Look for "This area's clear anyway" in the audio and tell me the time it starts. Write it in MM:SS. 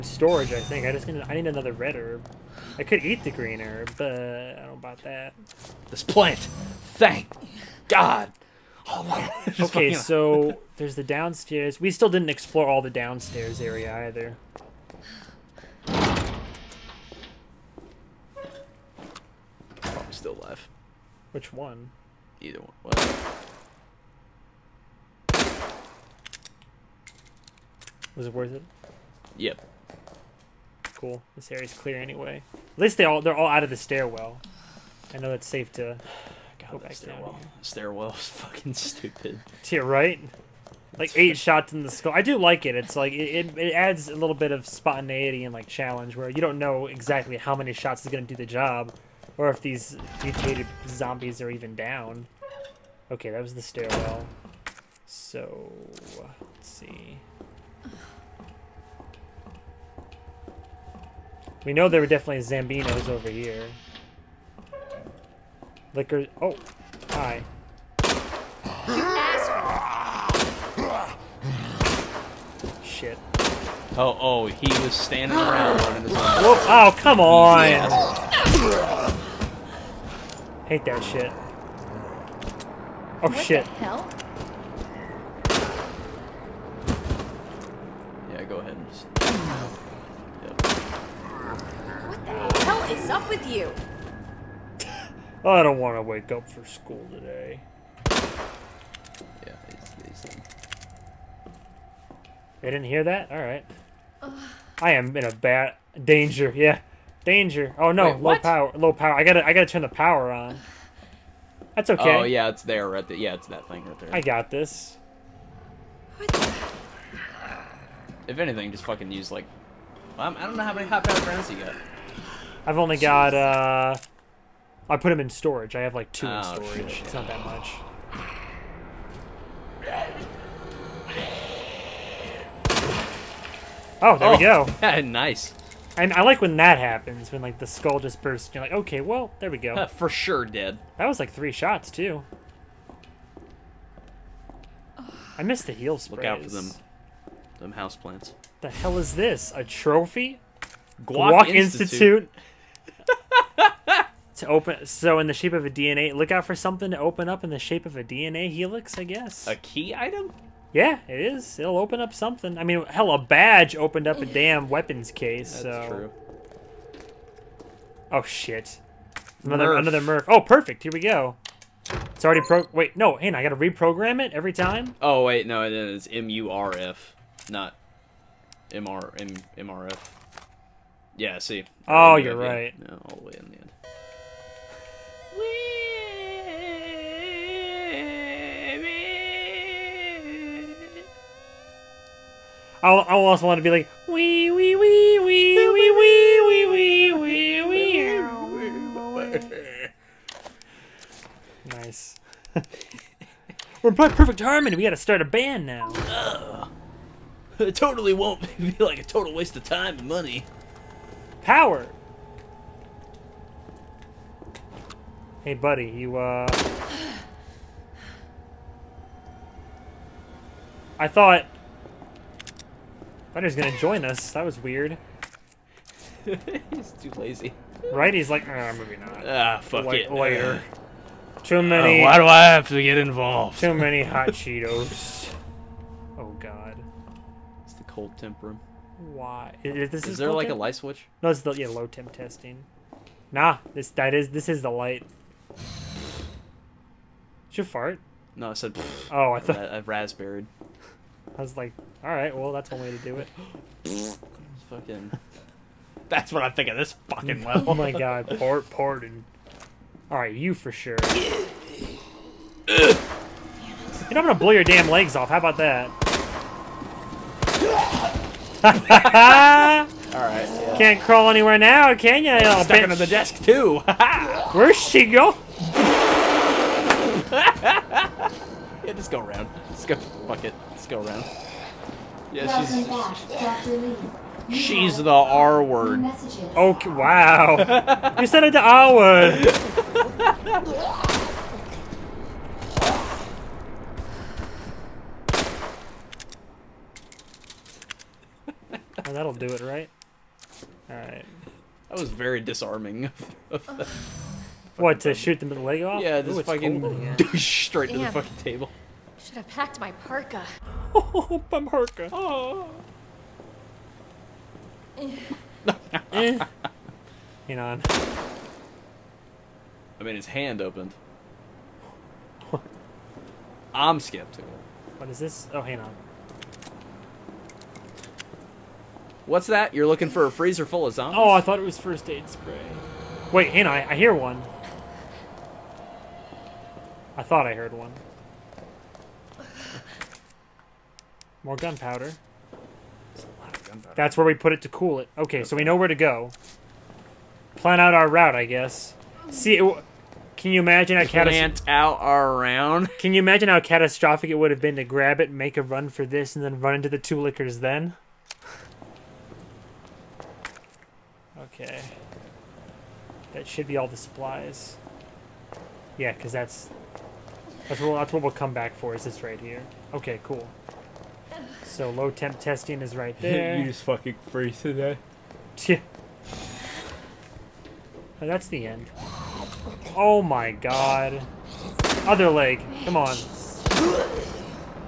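00:31.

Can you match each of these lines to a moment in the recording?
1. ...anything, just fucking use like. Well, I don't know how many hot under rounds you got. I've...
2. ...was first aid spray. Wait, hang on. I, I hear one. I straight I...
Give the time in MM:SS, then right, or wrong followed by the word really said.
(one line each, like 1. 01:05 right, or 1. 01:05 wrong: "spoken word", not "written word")
1. 01:58 wrong: "power", not "under"
2. 05:31 wrong: "thought", not "straight".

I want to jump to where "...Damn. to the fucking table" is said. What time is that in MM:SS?
05:07.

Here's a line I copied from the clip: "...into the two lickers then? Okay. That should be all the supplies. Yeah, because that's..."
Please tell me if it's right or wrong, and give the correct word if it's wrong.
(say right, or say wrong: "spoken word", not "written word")
right.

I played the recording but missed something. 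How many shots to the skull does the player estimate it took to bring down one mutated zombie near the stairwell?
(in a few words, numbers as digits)
8.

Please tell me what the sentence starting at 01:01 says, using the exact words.
We know there were definitely Zambinos over here.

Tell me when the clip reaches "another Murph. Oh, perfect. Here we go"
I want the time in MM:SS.
02:49.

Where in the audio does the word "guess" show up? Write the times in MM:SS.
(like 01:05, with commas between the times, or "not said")
02:39, 05:48.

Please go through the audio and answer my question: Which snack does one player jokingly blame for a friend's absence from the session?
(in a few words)
hot Cheetos.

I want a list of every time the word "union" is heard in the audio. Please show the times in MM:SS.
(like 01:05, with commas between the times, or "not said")
not said.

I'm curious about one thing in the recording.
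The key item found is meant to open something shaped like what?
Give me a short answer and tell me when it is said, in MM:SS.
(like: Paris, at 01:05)
DNA helix, at 02:38.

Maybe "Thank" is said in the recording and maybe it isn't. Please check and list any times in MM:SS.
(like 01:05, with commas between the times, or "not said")
00:06.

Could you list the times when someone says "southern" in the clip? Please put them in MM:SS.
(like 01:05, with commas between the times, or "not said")
not said.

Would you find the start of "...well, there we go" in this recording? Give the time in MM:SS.
02:19.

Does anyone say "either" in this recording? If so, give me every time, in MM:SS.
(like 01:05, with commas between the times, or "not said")
00:14, 00:22.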